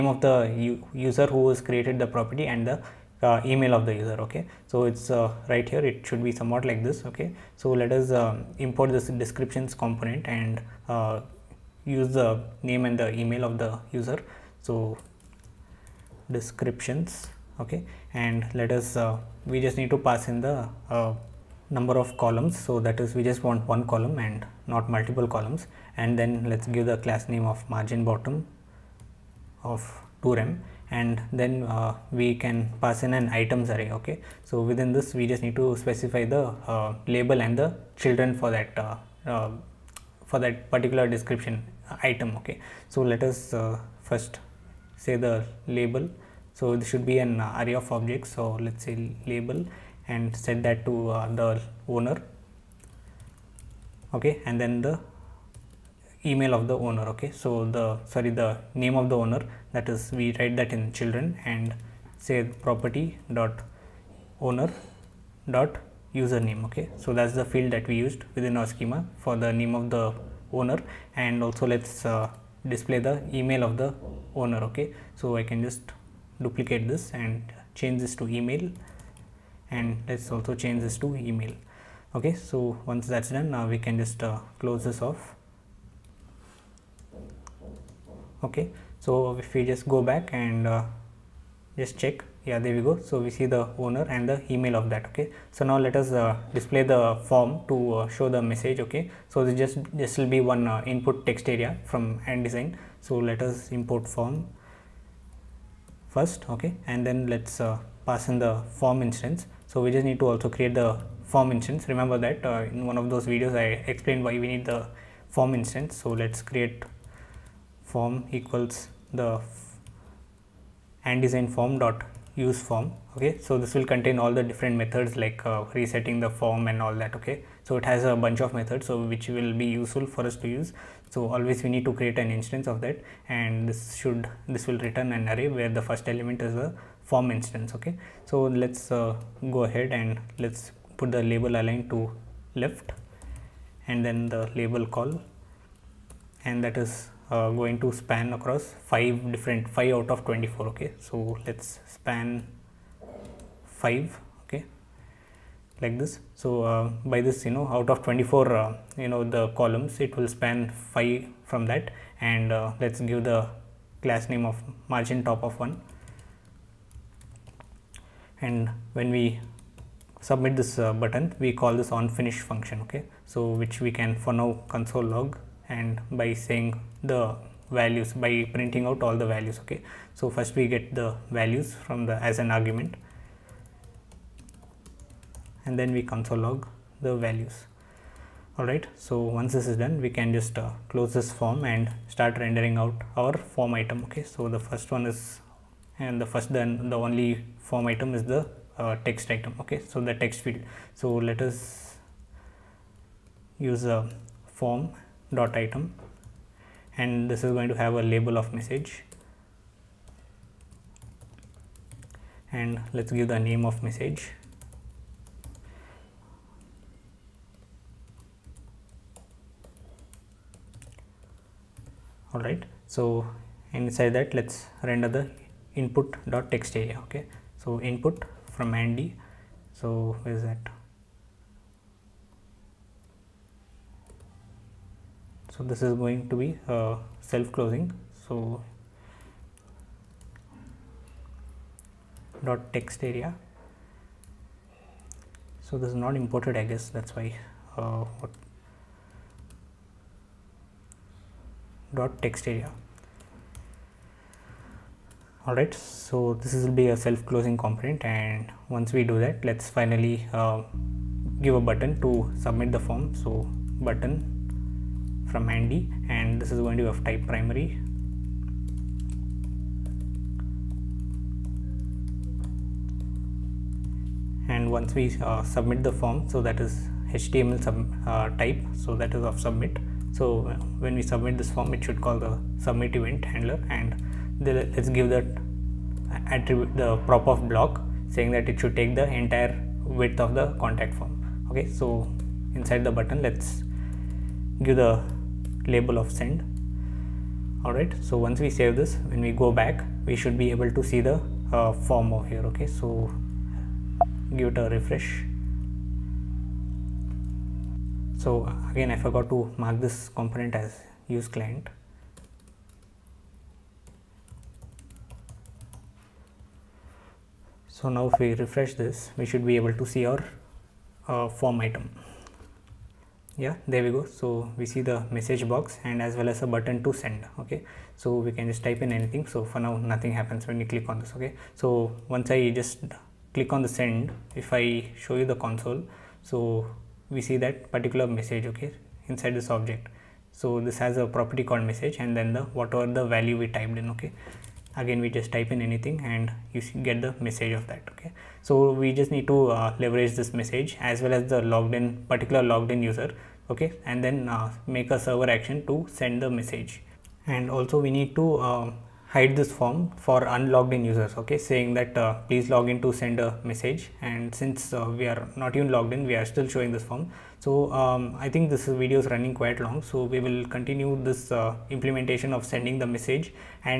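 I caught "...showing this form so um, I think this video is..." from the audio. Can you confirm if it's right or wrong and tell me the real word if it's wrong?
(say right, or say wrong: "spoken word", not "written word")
right.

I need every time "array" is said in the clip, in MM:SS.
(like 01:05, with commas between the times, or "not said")
00:33, 00:47, 02:15.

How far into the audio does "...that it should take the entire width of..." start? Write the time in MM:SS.
04:48.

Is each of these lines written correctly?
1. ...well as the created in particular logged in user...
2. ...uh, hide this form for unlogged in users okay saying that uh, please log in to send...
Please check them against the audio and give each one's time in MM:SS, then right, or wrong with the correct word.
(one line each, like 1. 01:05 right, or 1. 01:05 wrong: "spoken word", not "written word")
1. 05:51 wrong: "logged", not "created"
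2. 05:58 right.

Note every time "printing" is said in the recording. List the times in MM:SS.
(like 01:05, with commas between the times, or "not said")
02:58.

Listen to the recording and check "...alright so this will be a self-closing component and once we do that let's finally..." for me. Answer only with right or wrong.
right.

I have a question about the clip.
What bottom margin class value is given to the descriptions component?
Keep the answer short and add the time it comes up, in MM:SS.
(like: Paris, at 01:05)
2rem, at 00:30.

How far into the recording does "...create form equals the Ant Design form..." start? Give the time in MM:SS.
01:56.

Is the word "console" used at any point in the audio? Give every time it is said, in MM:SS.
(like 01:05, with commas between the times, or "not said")
02:54, 03:06, 05:35.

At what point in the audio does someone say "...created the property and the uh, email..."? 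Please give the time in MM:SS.
00:01.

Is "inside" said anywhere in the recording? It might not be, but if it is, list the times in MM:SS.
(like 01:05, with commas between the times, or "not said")
03:43, 04:52, 05:39.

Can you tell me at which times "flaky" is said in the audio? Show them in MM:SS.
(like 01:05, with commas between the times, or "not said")
not said.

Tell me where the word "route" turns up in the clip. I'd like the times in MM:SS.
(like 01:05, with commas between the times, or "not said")
not said.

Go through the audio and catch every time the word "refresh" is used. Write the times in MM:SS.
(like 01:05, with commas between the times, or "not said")
05:04, 05:18.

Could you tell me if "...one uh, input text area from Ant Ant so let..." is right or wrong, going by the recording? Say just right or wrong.
wrong.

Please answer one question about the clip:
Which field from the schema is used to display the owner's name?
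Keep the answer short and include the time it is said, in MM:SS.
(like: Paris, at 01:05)
username, at 01:02.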